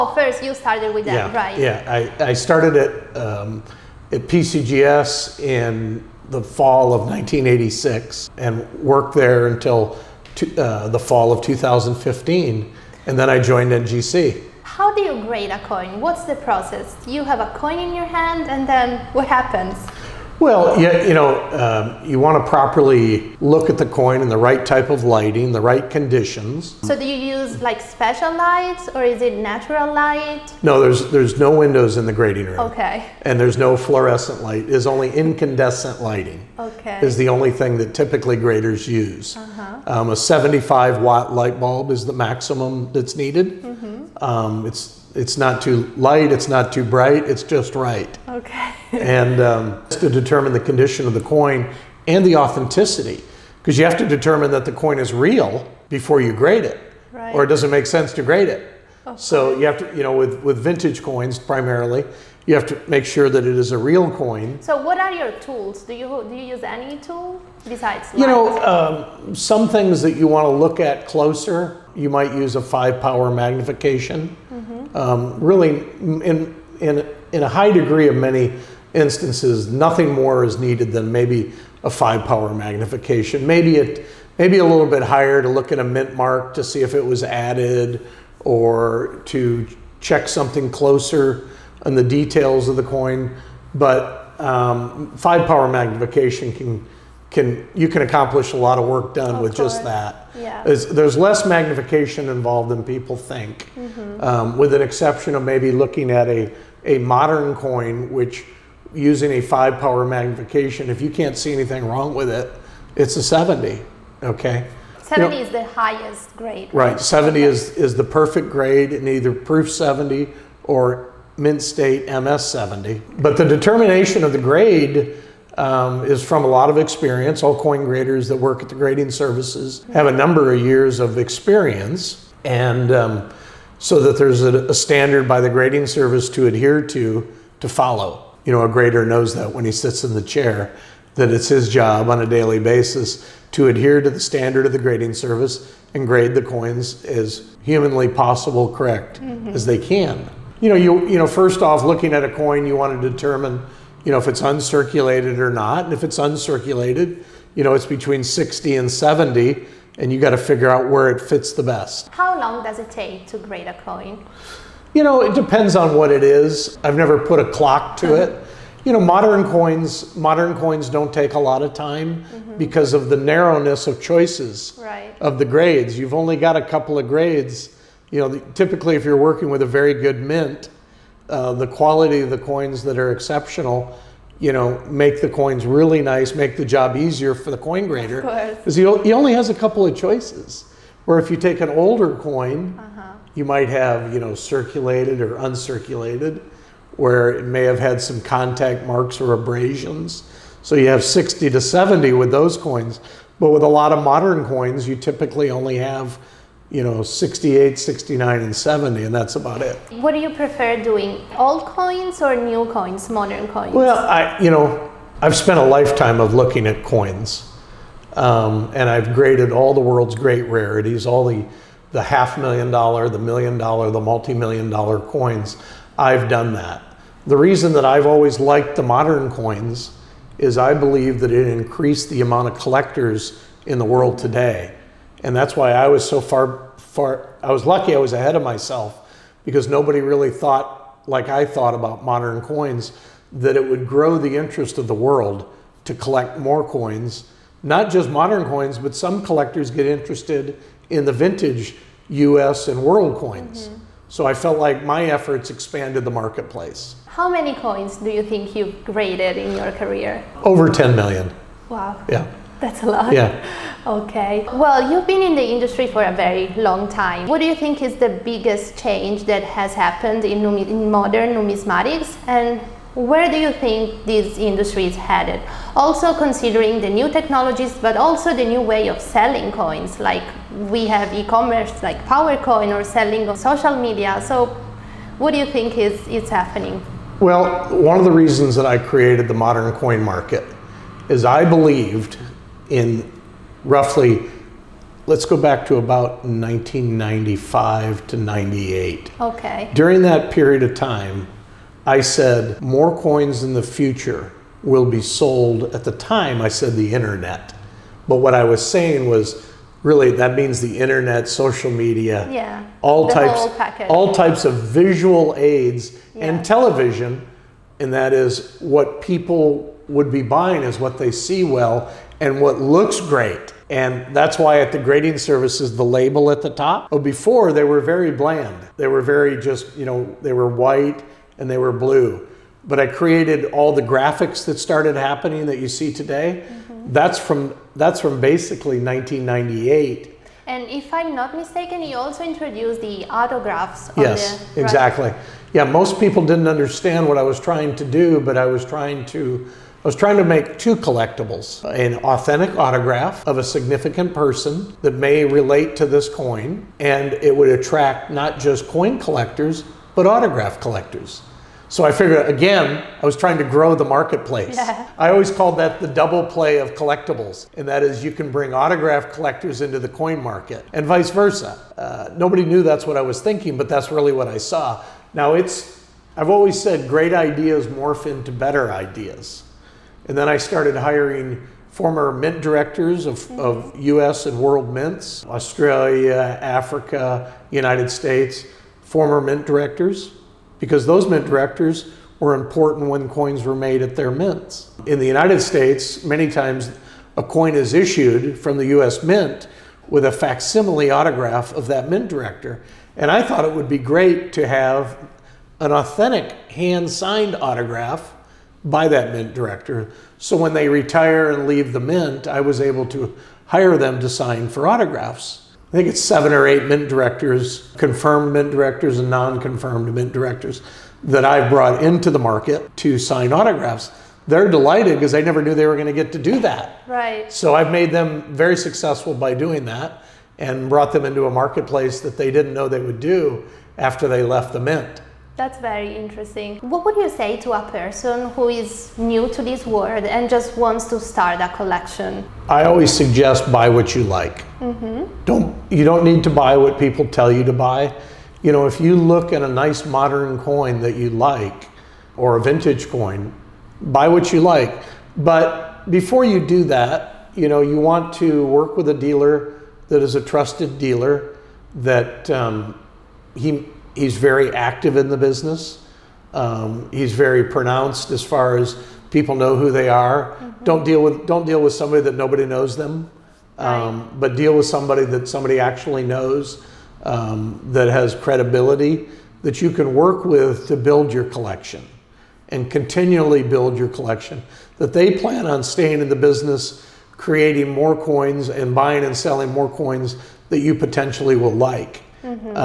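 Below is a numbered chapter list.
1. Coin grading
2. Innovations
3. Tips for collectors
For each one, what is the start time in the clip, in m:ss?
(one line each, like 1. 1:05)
1. 0:15
2. 4:23
3. 7:16.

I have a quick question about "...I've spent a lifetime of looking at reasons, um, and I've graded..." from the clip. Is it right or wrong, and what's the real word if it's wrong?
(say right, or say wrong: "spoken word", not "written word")
wrong: "coins", not "reasons".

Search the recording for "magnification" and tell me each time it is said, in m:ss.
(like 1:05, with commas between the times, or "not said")
1:13, 1:22, 1:35, 1:41, 1:50.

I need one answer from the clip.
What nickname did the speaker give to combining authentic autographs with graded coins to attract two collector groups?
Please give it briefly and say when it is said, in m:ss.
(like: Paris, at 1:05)
Double play of collectibles, at 6:05.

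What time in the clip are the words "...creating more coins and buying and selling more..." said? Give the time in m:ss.
8:07.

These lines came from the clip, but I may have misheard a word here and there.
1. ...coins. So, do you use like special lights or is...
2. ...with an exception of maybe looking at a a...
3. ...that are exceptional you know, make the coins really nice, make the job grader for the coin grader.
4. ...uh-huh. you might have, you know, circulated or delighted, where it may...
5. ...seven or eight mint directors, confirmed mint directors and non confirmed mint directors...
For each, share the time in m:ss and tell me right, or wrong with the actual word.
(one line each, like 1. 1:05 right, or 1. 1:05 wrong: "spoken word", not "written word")
1. 0:25 wrong: "conditions", not "coins"
2. 1:44 right
3. 3:02 wrong: "easier", not "grader"
4. 3:12 wrong: "uncirculated", not "delighted"
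5. 6:56 right.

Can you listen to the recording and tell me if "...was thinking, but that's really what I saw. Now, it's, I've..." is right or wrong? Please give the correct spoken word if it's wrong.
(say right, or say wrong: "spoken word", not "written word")
right.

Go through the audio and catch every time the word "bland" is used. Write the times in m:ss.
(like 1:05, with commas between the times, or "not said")
5:28.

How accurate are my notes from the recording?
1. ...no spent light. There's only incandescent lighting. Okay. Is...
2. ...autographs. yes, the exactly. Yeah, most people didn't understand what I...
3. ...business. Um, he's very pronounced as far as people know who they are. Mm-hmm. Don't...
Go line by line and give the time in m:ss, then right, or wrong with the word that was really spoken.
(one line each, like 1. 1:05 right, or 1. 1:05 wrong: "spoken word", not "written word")
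1. 0:33 wrong: "fluorescent", not "spent"
2. 5:43 right
3. 7:45 right.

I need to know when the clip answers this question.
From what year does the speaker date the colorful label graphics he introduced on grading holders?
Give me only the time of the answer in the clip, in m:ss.
5:38.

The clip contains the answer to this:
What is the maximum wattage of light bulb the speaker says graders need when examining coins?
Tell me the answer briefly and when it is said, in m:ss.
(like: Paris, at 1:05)
75 watt, at 0:40.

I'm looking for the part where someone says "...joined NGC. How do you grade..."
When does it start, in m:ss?
0:13.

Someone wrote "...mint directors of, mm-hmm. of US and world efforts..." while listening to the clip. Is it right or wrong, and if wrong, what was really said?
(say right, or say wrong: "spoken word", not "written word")
wrong: "mints", not "efforts".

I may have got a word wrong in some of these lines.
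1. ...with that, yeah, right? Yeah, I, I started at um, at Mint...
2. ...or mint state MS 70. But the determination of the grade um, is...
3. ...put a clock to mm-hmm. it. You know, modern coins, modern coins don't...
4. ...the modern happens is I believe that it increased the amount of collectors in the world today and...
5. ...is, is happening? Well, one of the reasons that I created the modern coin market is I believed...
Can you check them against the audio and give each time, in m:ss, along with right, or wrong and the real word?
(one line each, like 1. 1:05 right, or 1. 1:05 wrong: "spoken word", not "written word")
1. 0:00 wrong: "PCGS", not "Mint"
2. 2:00 right
3. 2:47 right
4. 3:48 wrong: "coins", not "happens"
5. 4:45 right.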